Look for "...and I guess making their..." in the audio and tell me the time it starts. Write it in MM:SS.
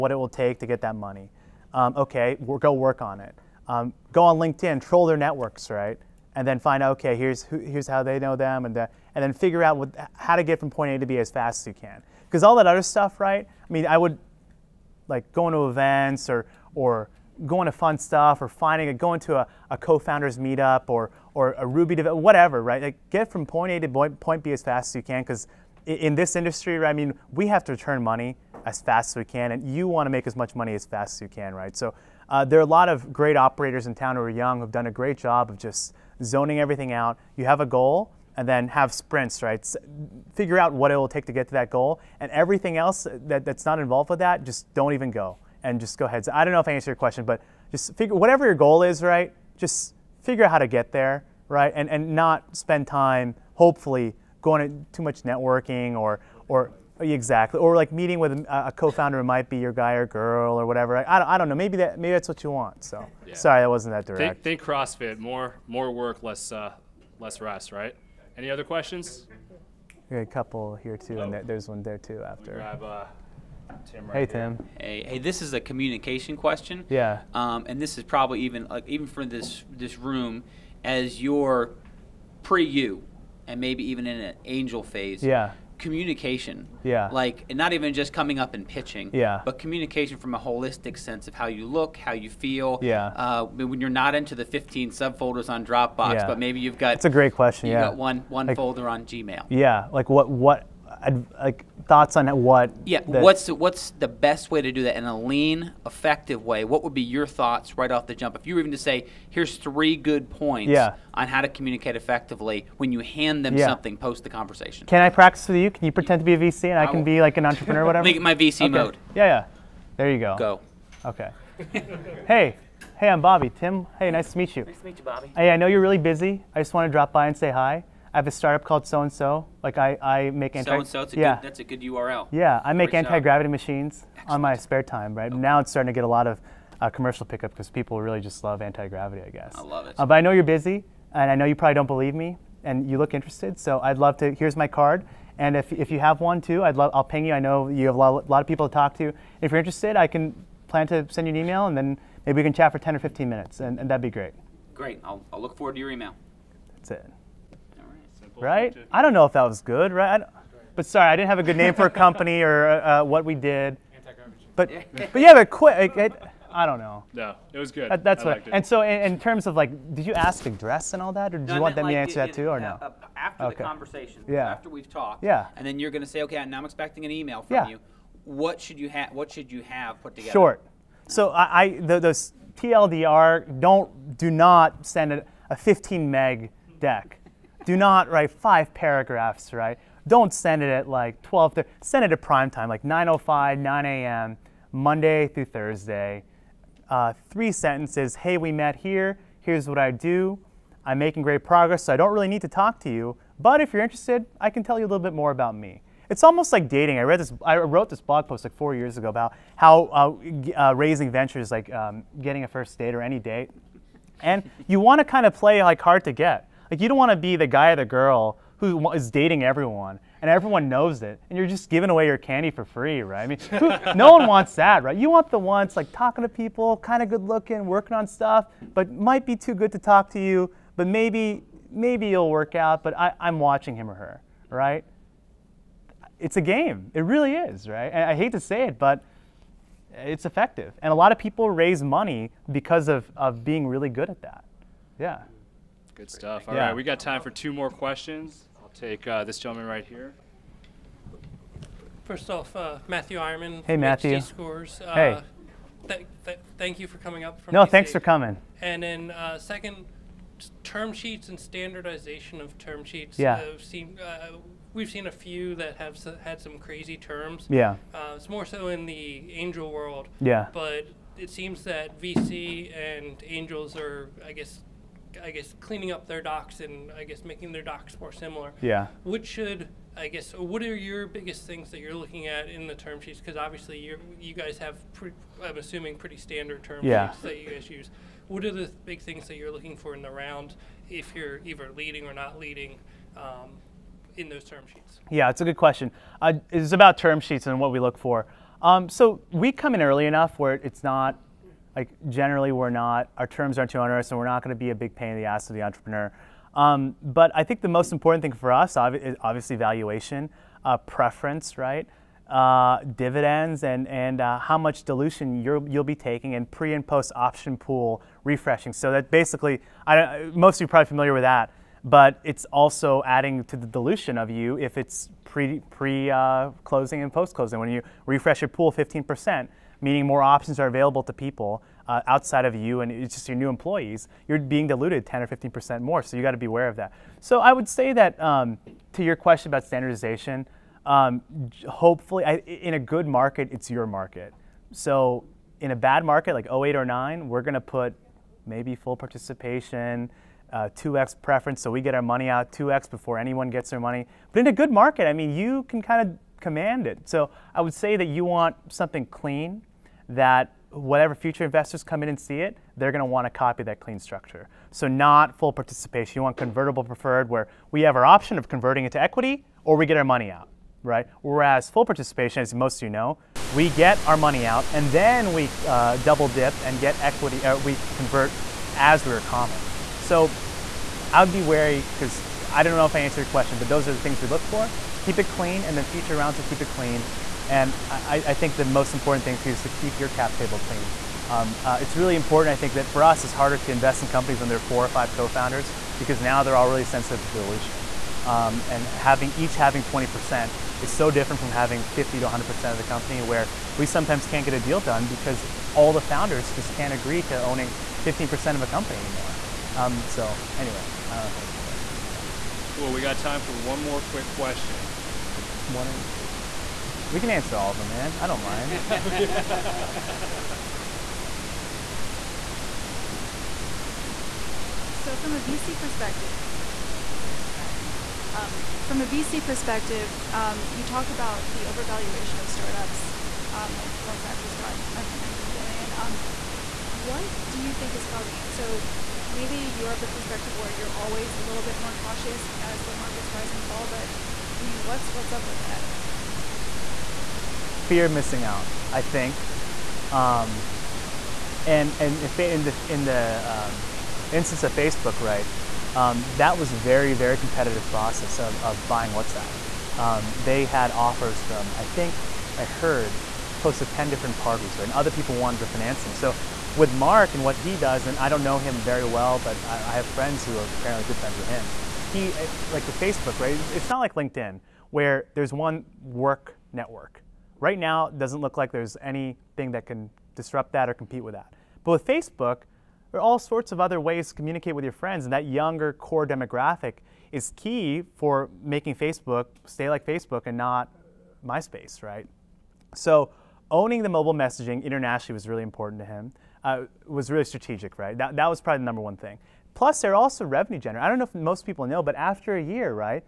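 04:36.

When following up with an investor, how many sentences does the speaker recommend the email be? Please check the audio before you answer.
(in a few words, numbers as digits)
3.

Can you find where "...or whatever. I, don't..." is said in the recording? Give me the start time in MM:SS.
01:00.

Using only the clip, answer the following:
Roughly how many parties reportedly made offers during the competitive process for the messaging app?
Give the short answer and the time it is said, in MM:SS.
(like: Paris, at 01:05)
10, at 07:43.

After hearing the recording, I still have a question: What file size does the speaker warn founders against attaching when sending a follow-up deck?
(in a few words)
15 meg.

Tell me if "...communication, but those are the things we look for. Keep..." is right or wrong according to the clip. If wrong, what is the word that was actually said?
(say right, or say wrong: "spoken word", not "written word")
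wrong: "question", not "communication".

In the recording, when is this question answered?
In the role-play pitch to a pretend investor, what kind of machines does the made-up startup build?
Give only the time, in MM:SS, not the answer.
02:12.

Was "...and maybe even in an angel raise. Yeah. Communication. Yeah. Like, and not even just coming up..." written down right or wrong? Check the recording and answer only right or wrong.
wrong.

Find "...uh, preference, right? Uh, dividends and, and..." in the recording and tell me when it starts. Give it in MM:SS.
05:10.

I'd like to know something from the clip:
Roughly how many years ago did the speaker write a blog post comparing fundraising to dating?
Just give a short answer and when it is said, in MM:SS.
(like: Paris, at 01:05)
4, at 03:28.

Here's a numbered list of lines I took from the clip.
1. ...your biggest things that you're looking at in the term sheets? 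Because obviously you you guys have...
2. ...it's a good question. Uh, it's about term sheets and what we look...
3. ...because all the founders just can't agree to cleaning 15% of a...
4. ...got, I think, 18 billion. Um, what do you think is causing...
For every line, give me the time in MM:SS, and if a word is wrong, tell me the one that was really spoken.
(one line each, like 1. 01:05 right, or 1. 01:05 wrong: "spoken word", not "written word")
1. 04:40 right
2. 04:55 right
3. 06:45 wrong: "owning", not "cleaning"
4. 07:14 wrong: "19", not "18".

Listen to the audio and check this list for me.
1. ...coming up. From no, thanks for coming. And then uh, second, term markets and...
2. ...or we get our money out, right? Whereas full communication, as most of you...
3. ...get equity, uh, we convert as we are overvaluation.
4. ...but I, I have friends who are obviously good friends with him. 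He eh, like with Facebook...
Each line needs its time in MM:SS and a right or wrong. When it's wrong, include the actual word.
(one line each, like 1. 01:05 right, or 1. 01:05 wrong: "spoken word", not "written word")
1. 04:16 wrong: "sheets", not "markets"
2. 06:09 wrong: "participation", not "communication"
3. 06:16 wrong: "common", not "overvaluation"
4. 07:49 wrong: "apparently", not "obviously".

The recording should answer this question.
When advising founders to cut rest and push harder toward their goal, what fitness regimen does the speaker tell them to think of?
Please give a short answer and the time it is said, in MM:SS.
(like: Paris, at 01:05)
CrossFit, at 01:04.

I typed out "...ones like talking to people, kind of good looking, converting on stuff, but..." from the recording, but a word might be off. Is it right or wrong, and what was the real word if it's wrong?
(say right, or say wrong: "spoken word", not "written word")
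wrong: "working", not "converting".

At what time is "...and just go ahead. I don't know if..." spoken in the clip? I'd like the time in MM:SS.
00:45.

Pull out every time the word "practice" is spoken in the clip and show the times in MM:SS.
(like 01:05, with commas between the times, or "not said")
01:55.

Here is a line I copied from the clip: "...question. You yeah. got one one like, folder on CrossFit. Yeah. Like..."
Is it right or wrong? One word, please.
wrong.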